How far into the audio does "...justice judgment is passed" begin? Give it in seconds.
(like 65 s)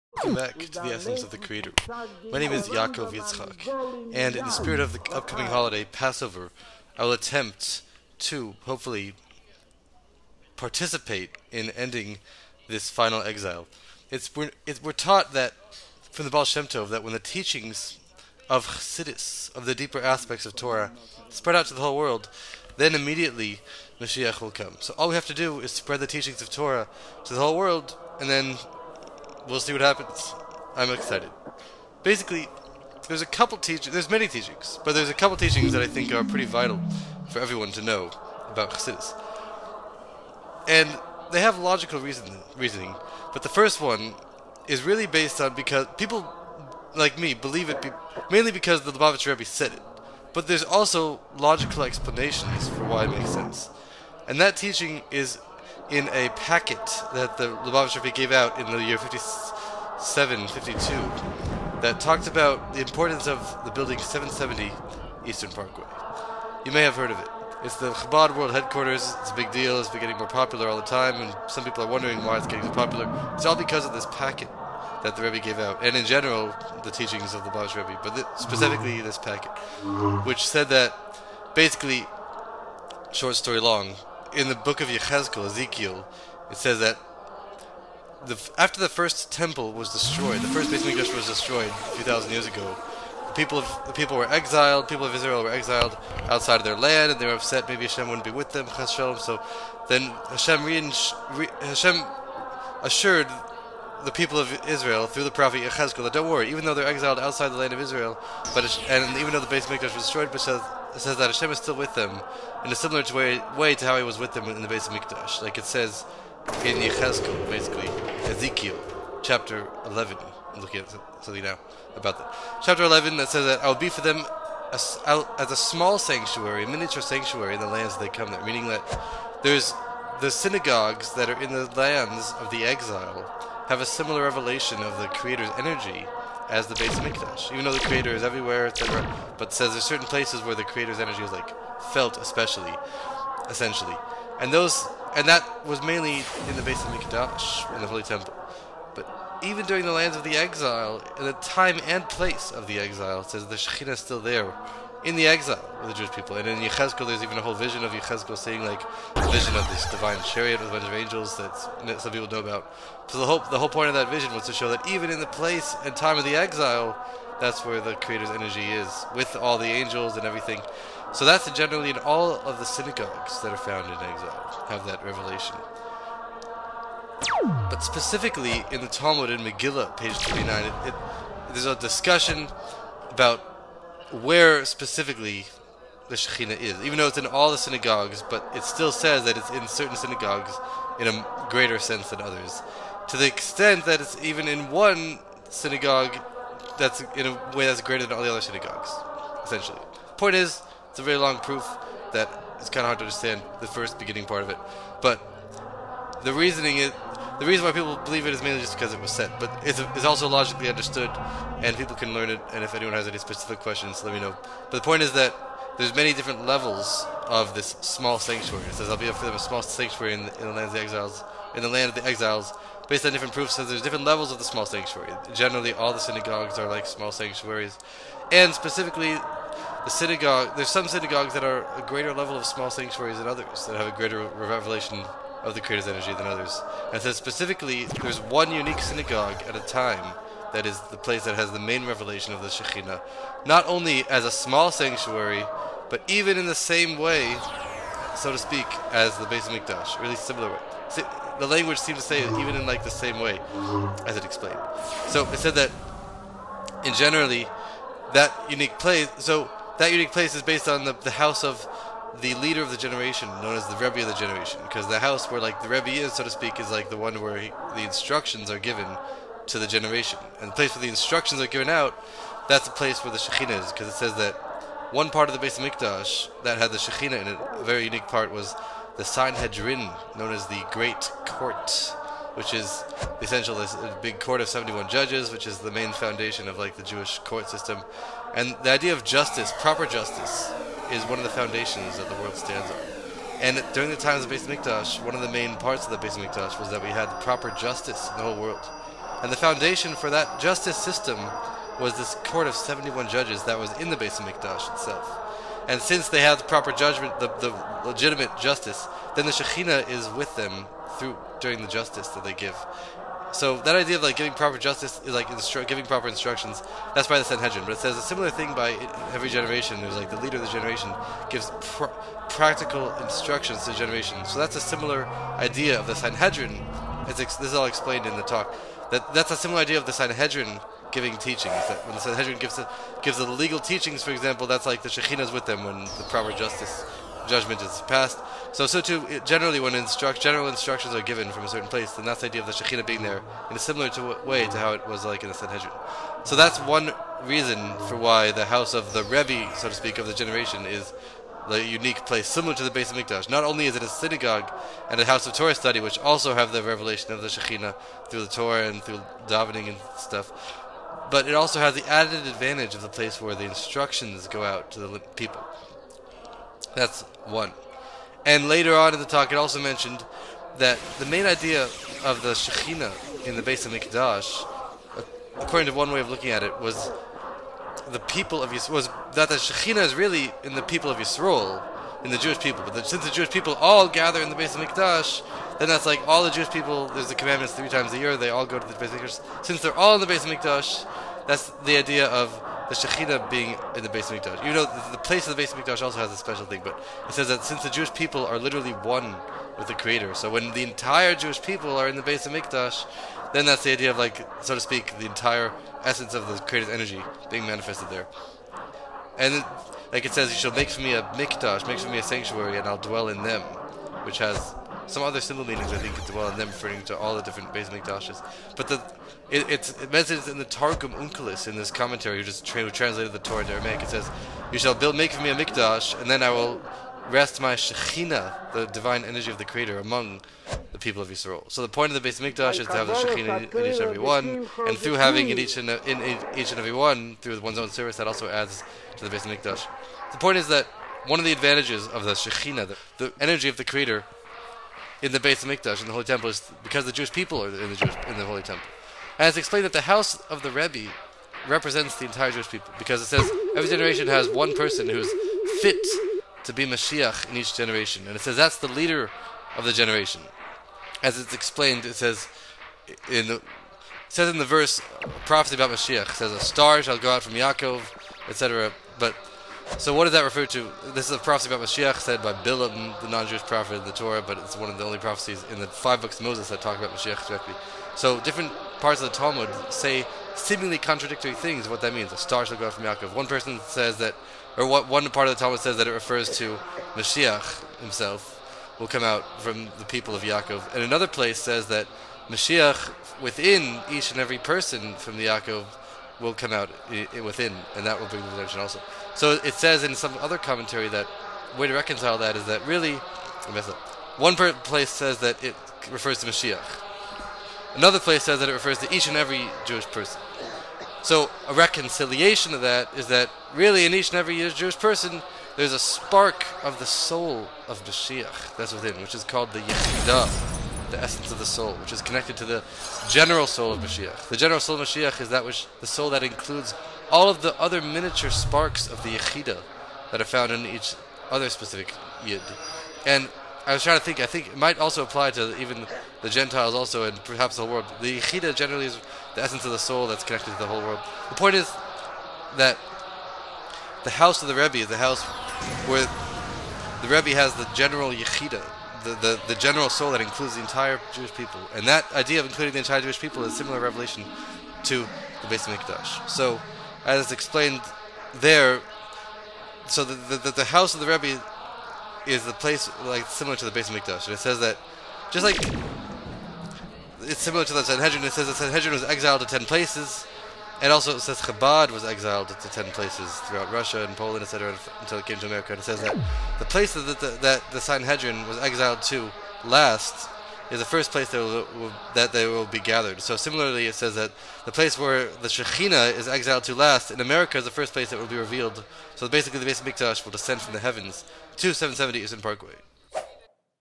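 336 s.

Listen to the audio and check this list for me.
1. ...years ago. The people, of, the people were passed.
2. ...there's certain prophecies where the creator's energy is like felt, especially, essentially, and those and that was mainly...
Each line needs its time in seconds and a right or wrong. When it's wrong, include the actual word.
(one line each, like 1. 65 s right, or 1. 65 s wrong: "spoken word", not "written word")
1. 92 s wrong: "exiled", not "passed"
2. 139 s wrong: "places", not "prophecies".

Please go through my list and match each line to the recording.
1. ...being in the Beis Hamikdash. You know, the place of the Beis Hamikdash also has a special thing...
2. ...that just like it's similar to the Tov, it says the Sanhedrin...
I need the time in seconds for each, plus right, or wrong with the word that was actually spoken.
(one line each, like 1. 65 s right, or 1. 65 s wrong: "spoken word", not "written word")
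1. 393 s right
2. 564 s wrong: "Sanhedrin", not "Tov".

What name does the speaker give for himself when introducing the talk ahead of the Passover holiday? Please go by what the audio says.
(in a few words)
Yaakov Yitzchak.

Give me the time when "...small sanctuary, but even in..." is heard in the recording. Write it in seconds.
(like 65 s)
244 s.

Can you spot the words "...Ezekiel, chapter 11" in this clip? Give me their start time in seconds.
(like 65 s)
118 s.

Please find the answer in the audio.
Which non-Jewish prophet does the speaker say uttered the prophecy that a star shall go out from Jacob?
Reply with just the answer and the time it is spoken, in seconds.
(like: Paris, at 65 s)
Bilam, at 472 s.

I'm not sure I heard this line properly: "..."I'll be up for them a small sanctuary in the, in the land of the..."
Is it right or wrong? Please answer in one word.
right.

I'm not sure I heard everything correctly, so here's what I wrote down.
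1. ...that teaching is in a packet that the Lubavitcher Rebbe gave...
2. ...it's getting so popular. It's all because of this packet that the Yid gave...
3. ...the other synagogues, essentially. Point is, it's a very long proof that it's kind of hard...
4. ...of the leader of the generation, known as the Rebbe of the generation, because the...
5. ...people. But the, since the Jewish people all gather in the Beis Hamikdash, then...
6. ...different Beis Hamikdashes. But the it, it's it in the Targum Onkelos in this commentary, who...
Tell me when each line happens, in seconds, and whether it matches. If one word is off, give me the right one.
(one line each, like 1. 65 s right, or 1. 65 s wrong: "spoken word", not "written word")
1. 54 s right
2. 72 s wrong: "Rebbe", not "Yid"
3. 198 s right
4. 261 s right
5. 382 s right
6. 417 s right.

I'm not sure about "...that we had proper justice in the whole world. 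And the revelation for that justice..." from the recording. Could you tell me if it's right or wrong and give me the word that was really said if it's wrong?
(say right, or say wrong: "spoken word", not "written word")
wrong: "foundation", not "revelation".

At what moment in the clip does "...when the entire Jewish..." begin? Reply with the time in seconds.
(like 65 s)
400 s.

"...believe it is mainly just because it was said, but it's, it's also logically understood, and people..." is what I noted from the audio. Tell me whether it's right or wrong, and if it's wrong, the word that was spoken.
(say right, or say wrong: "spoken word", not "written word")
right.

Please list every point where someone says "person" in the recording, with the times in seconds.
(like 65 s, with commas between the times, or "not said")
454 s, 483 s, 494 s, 509 s, 514 s.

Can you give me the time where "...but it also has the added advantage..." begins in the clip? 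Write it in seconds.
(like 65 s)
361 s.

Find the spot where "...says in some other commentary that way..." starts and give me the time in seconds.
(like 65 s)
499 s.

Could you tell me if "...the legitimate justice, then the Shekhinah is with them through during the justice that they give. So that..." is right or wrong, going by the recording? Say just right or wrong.
right.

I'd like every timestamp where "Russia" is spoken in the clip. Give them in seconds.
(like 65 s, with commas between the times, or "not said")
573 s.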